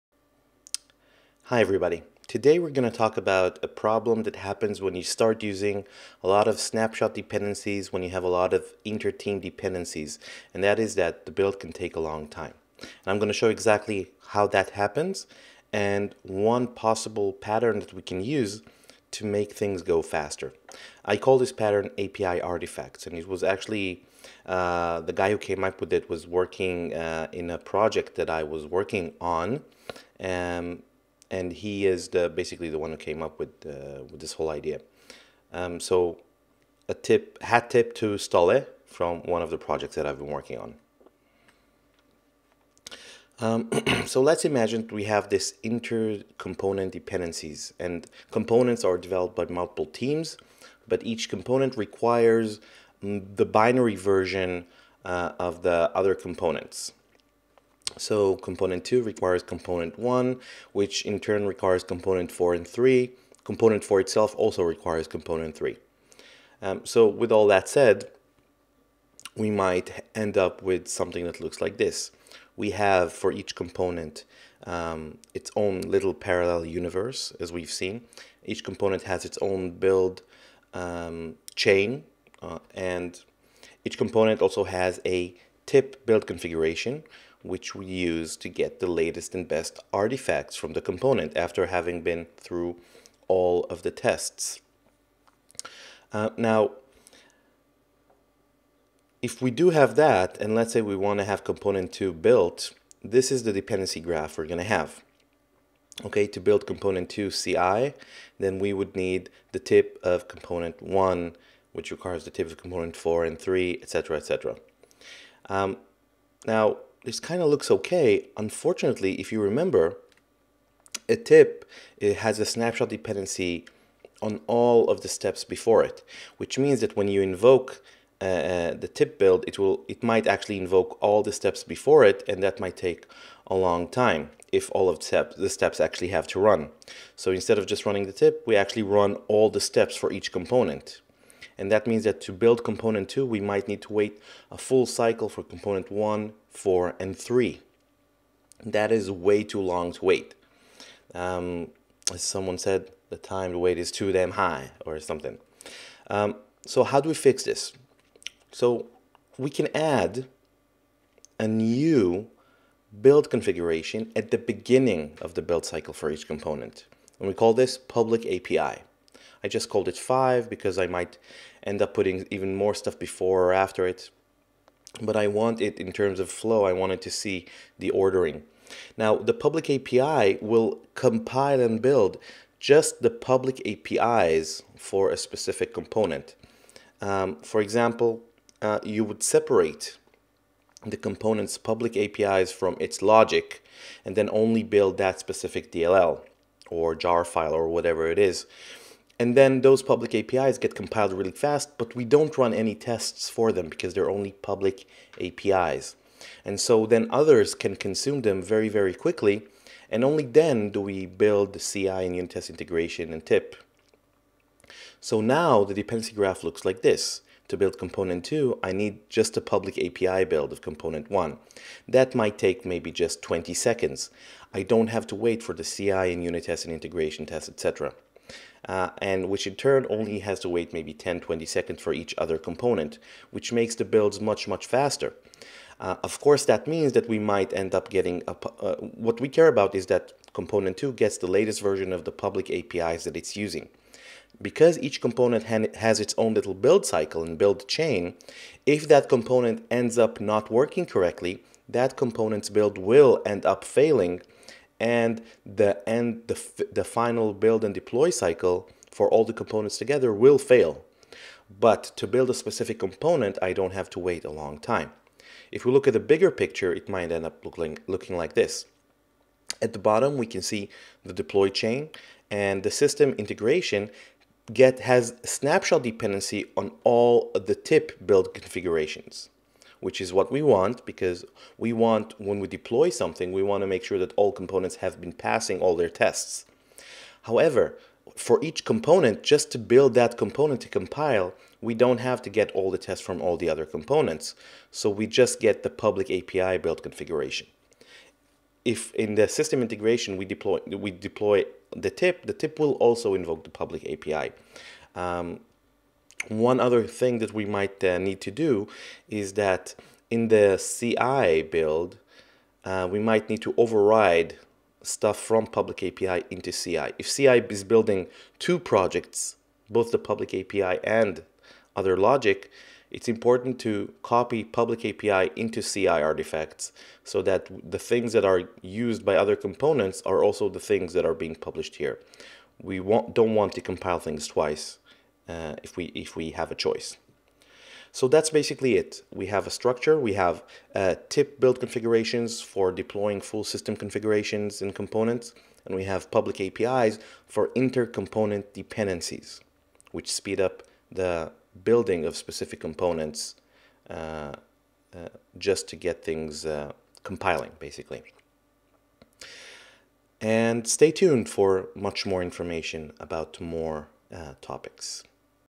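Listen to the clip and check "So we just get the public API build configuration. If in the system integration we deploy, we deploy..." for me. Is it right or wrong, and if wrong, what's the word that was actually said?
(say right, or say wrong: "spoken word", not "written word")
right.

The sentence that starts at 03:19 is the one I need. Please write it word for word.
And then those public APIs get compiled really fast, but we don't run any tests for them because they're only public APIs.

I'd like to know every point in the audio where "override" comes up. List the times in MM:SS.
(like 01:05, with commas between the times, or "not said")
05:13.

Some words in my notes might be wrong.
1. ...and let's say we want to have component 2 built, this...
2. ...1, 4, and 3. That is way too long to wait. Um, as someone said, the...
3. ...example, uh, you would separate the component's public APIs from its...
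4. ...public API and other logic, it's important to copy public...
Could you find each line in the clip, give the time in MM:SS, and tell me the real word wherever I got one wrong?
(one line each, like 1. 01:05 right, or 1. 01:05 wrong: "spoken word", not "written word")
1. 01:40 right
2. 02:25 right
3. 03:07 right
4. 05:19 right.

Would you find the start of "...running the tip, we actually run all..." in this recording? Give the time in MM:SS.
02:17.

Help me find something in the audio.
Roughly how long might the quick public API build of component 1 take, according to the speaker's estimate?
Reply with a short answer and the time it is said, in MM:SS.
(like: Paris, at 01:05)
20 seconds, at 03:43.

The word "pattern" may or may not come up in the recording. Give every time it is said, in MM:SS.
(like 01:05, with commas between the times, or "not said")
00:17, 00:21.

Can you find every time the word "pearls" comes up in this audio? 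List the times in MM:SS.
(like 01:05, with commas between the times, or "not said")
not said.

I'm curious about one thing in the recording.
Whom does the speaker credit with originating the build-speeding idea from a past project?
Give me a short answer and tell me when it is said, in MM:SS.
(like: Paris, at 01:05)
Stolle, at 00:38.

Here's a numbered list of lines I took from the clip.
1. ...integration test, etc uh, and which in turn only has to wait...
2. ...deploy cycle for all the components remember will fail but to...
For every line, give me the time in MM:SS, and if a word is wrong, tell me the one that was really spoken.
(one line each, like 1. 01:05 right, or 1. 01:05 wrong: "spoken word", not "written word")
1. 03:46 right
2. 04:17 wrong: "together", not "remember".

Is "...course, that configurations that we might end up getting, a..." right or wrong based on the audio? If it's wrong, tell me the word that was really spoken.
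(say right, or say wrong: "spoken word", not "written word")
wrong: "means", not "configurations".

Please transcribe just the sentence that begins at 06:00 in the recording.
And stay tuned for much more information about more uh, topics.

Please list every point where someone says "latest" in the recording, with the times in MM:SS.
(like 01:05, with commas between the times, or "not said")
01:28, 04:01.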